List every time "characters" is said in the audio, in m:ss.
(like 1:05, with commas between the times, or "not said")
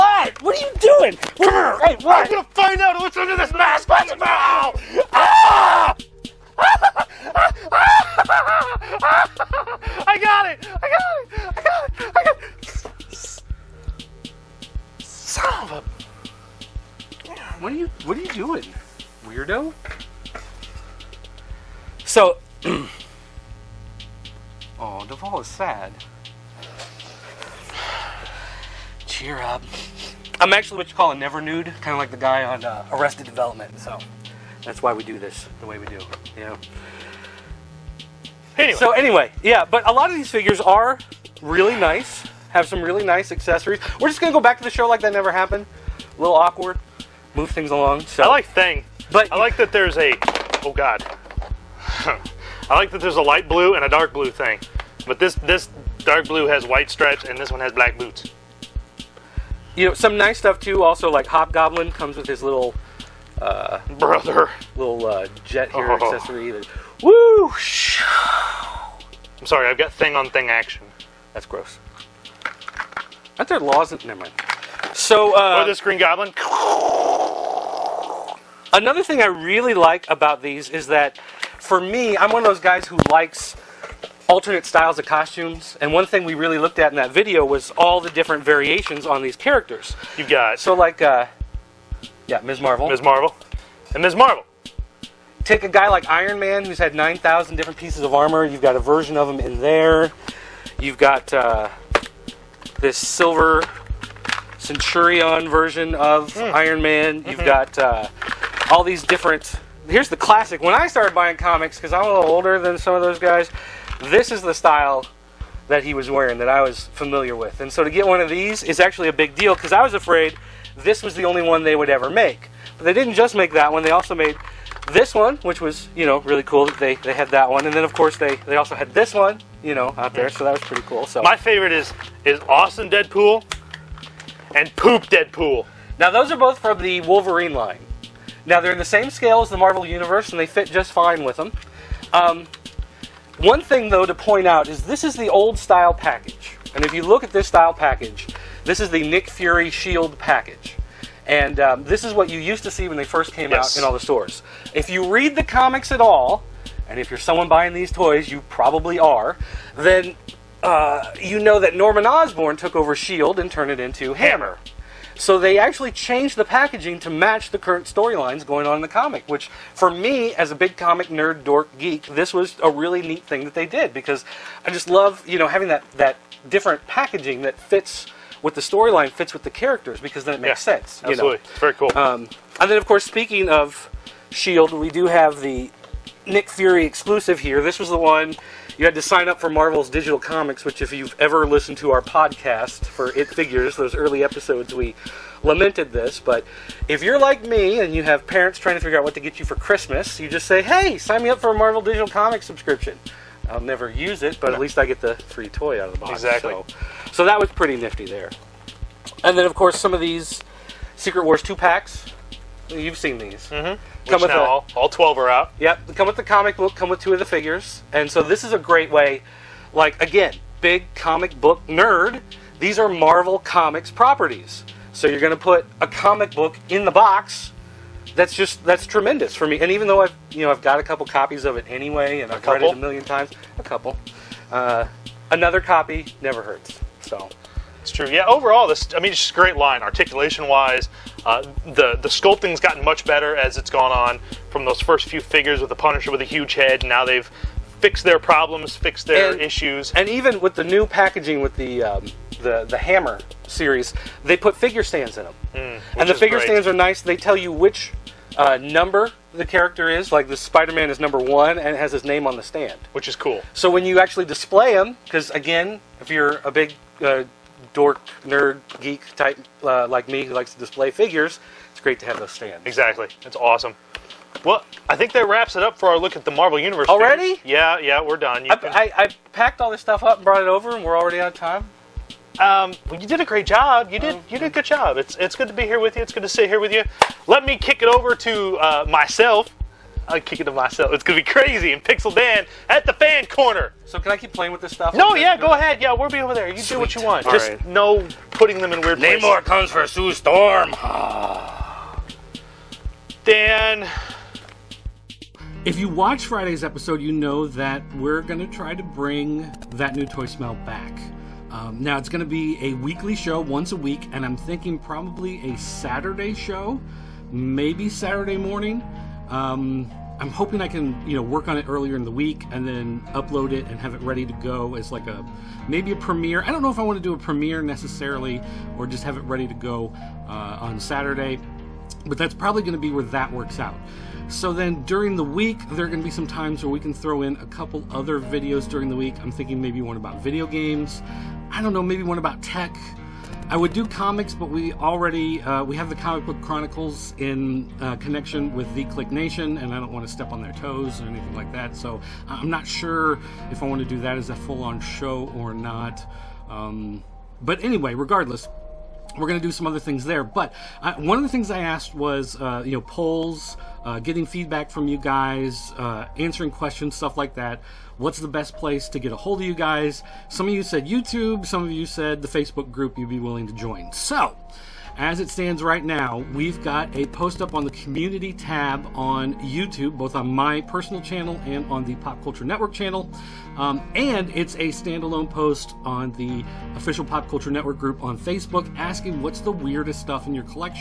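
1:29, 2:59, 4:19.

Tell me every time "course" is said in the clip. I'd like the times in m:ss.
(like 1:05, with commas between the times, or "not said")
2:07, 3:02, 3:29.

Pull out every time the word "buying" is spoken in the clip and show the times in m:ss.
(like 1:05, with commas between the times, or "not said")
1:51, 2:37.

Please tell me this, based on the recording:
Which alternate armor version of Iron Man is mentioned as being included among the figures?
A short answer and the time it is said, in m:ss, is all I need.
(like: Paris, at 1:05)
Silver Centurion, at 1:42.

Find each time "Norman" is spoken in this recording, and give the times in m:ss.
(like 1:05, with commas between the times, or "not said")
2:41.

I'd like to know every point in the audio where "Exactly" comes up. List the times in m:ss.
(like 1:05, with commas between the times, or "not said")
3:26, 4:32.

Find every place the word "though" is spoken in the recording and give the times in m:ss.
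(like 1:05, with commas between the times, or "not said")
2:23, 3:49.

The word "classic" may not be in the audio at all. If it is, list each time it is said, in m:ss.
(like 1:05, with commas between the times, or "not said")
1:50.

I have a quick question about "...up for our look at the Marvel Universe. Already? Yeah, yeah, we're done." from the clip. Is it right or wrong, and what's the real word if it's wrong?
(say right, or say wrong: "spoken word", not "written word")
right.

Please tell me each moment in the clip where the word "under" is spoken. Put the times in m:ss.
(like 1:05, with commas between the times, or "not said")
0:03.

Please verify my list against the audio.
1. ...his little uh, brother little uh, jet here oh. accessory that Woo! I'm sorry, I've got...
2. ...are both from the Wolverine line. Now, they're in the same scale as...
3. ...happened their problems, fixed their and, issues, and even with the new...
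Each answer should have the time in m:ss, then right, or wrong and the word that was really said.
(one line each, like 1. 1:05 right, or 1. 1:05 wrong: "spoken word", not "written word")
1. 1:02 right
2. 2:16 right
3. 4:07 wrong: "fixed", not "happened".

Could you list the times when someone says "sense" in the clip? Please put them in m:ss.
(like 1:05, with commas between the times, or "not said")
3:00.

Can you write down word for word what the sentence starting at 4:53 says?
So can I keep playing with this stuff?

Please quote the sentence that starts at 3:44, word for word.
So you're going to put a comic book in the box that's just that's tremendous for me.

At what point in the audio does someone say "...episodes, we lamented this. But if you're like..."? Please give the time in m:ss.
3:14.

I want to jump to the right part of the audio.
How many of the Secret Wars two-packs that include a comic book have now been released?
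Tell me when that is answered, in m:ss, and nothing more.
3:34.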